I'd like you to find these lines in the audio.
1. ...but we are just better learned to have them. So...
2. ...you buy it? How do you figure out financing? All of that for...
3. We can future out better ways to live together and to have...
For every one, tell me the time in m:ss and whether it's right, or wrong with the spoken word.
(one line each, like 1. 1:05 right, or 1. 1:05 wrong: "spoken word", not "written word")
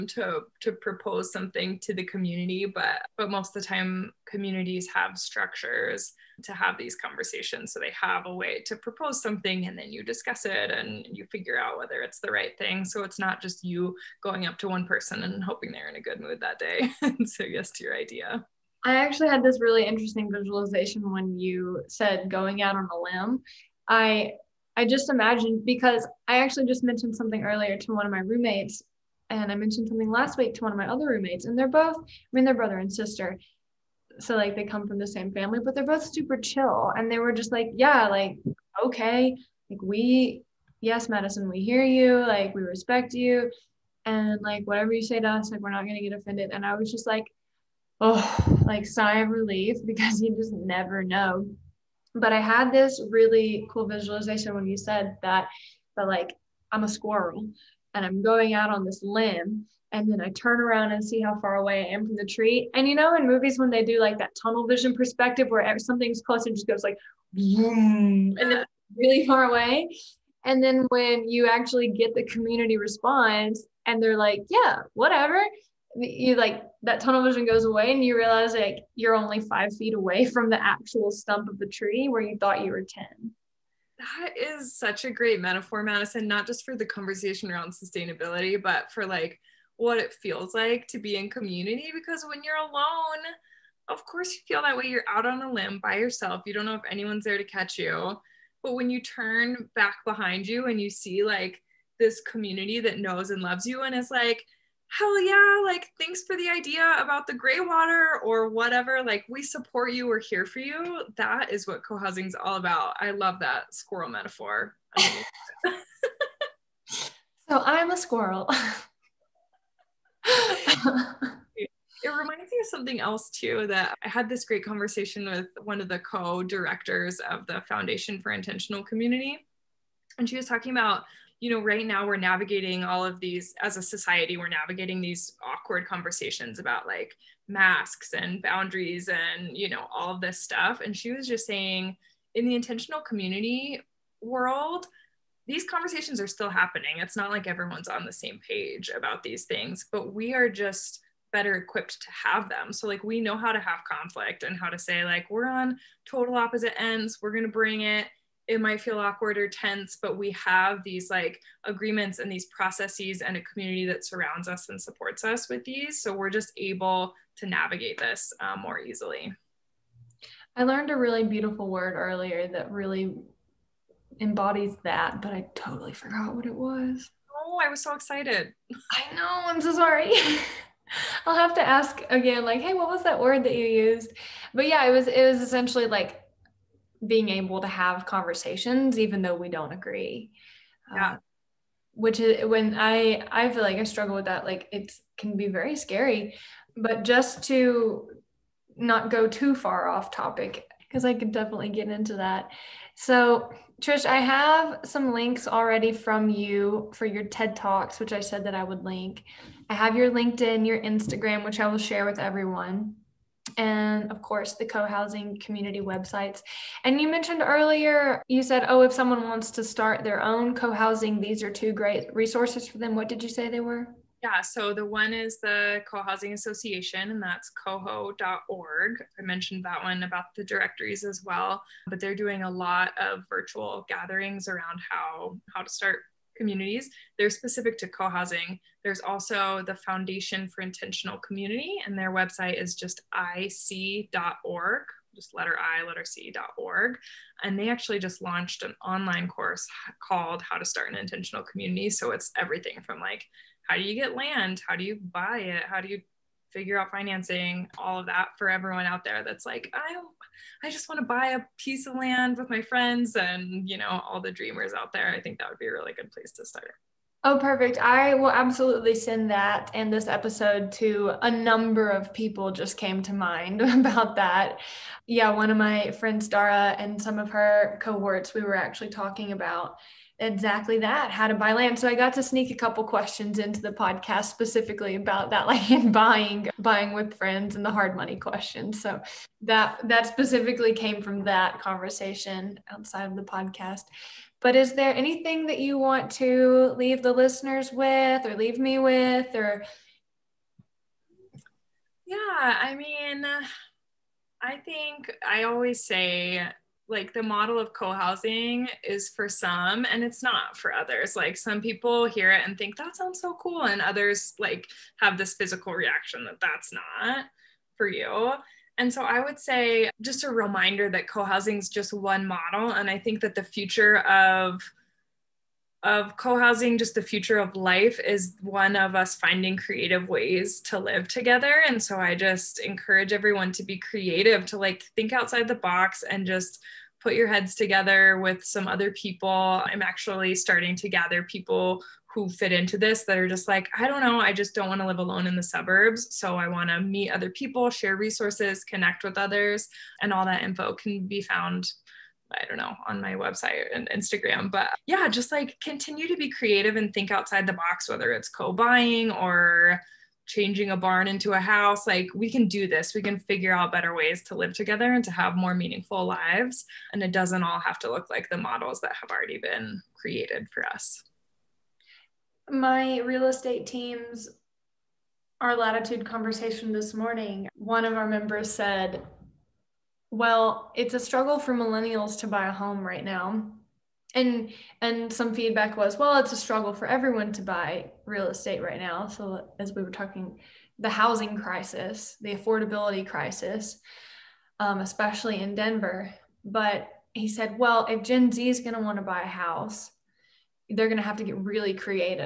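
1. 2:29 wrong: "equipped", not "learned"
2. 4:14 right
3. 6:02 wrong: "figure", not "future".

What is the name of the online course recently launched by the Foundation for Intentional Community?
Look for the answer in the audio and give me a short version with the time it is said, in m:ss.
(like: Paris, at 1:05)
How to Start an Intentional Community, at 4:10.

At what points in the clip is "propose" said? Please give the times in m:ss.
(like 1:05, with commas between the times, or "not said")
0:00, 0:08.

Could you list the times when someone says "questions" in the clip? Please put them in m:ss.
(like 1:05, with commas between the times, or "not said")
4:42, 4:48.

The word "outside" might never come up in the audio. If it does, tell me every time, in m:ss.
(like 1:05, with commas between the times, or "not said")
4:52, 5:35, 5:57.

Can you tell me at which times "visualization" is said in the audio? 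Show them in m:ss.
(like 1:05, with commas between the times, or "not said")
0:20, 0:53.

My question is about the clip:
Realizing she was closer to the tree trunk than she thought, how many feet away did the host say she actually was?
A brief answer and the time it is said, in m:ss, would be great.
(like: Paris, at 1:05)
5, at 1:19.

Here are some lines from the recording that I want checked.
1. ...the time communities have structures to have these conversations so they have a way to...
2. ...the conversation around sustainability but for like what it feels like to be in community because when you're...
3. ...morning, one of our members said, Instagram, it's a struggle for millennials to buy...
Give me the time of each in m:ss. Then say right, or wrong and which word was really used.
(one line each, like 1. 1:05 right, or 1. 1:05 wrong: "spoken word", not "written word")
1. 0:03 right
2. 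1:26 right
3. 6:16 wrong: "Well", not "Instagram".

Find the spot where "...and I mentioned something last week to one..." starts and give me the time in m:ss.
0:29.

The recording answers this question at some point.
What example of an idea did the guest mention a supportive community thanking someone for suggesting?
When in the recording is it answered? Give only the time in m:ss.
1:47.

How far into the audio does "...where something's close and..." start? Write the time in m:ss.
1:05.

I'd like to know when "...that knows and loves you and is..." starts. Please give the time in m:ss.
1:42.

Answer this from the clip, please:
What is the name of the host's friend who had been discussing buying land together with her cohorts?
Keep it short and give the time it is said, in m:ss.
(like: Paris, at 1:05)
Dara, at 4:36.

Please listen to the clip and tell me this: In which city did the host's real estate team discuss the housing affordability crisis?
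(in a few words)
Denver.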